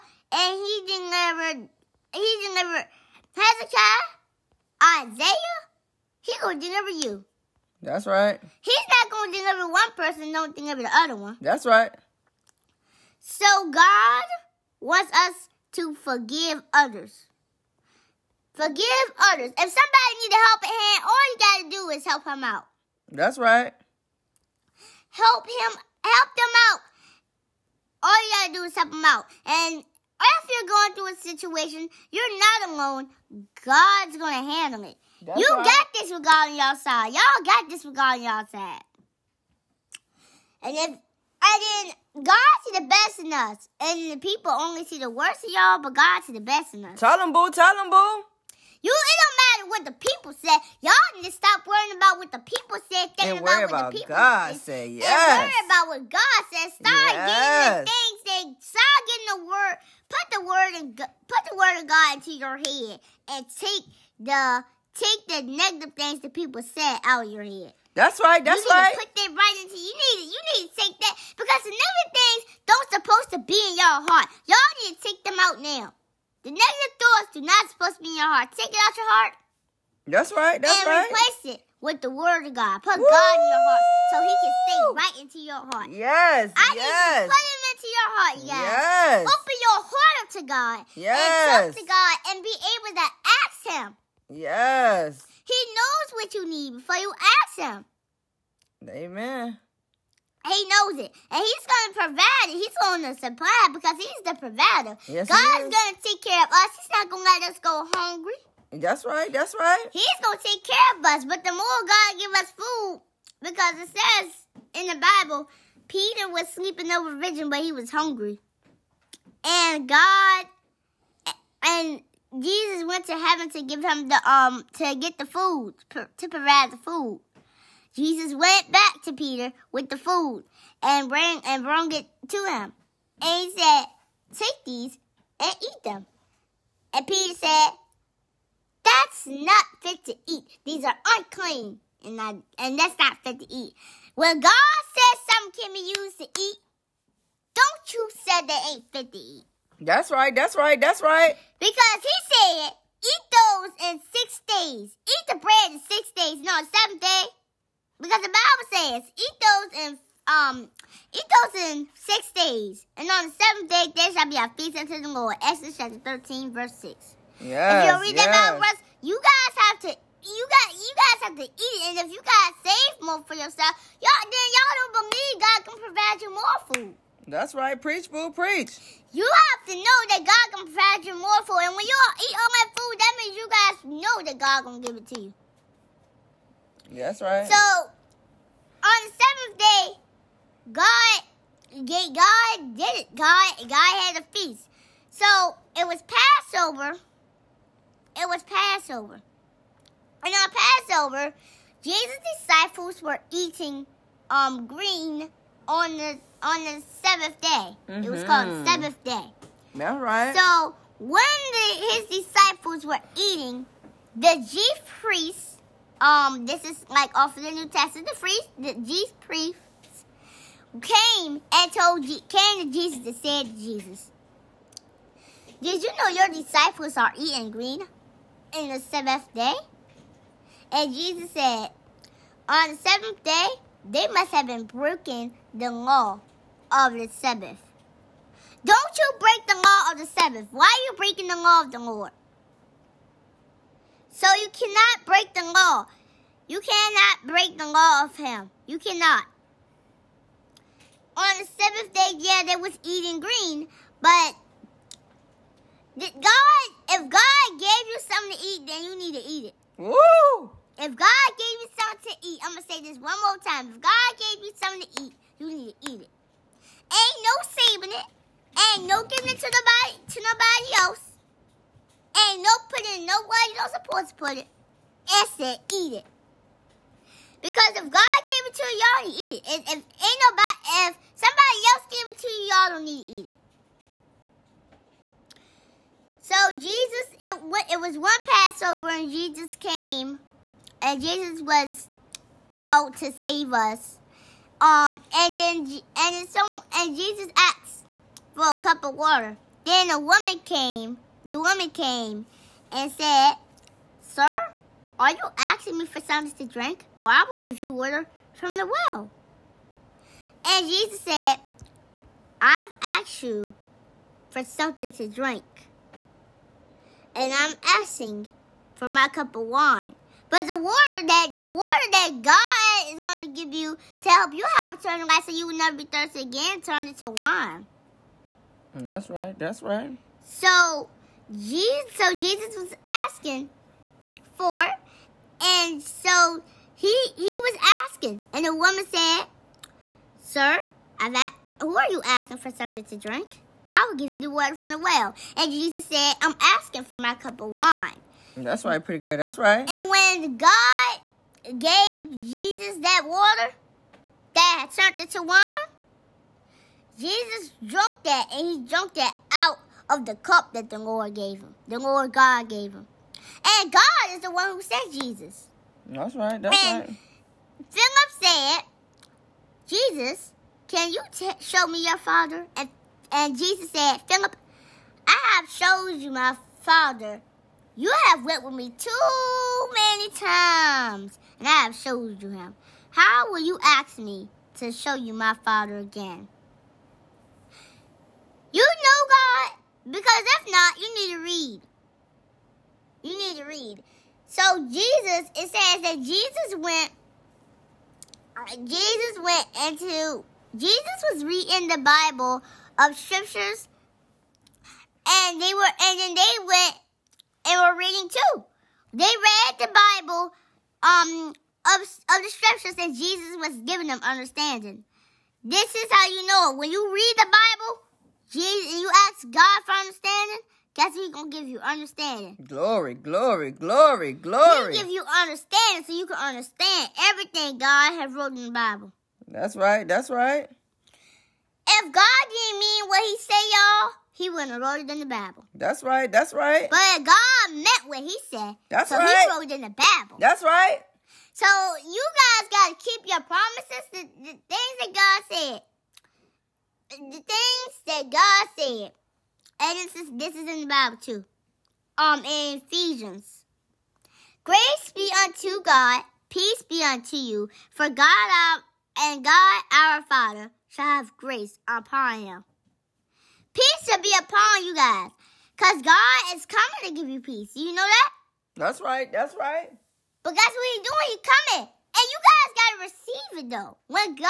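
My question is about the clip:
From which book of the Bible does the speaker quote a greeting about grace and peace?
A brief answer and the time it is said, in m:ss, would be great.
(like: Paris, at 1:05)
Ephesians, at 7:32.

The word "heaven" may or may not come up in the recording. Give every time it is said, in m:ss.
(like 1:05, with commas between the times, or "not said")
2:03.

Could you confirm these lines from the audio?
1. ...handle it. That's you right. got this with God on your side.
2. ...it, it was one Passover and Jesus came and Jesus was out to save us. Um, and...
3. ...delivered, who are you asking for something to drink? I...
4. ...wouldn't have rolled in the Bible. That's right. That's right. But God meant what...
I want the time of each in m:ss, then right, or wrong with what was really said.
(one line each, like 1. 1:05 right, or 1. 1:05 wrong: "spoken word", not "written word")
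1. 0:34 right
2. 4:47 right
3. 5:41 wrong: "asked", not "delivered"
4. 7:14 right.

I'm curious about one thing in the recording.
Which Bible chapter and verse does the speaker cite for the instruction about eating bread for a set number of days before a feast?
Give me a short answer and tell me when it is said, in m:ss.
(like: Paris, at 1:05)
Exodus 13:6, at 2:45.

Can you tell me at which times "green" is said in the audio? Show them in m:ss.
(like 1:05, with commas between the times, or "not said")
3:24, 3:47, 4:13.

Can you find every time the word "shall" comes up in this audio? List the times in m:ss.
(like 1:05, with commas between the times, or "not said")
2:44, 7:40.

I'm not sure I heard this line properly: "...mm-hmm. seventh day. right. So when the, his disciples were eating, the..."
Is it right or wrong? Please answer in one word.
right.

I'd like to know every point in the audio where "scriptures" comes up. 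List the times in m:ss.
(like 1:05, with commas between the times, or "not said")
6:42, 6:52.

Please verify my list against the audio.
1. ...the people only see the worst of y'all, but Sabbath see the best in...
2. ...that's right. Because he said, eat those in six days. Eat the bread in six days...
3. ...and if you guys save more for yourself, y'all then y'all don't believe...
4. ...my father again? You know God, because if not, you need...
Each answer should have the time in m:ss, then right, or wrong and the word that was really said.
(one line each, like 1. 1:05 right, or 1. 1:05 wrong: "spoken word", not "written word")
1. 0:44 wrong: "God", not "Sabbath"
2. 2:30 right
3. 2:51 right
4. 6:25 right.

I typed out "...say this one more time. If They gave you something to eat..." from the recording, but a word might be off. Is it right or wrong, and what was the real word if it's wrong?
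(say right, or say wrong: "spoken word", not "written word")
wrong: "God", not "They".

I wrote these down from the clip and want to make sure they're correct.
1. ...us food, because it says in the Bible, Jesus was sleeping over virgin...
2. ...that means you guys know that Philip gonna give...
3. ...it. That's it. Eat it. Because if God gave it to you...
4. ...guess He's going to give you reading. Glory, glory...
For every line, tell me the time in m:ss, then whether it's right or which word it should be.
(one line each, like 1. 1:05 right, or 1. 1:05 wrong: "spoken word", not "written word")
1. 1:52 wrong: "Peter", not "Jesus"
2. 3:02 wrong: "God", not "Philip"
3. 4:34 right
4. 7:00 wrong: "understanding", not "reading".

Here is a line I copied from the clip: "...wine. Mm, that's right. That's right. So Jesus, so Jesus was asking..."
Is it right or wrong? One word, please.
right.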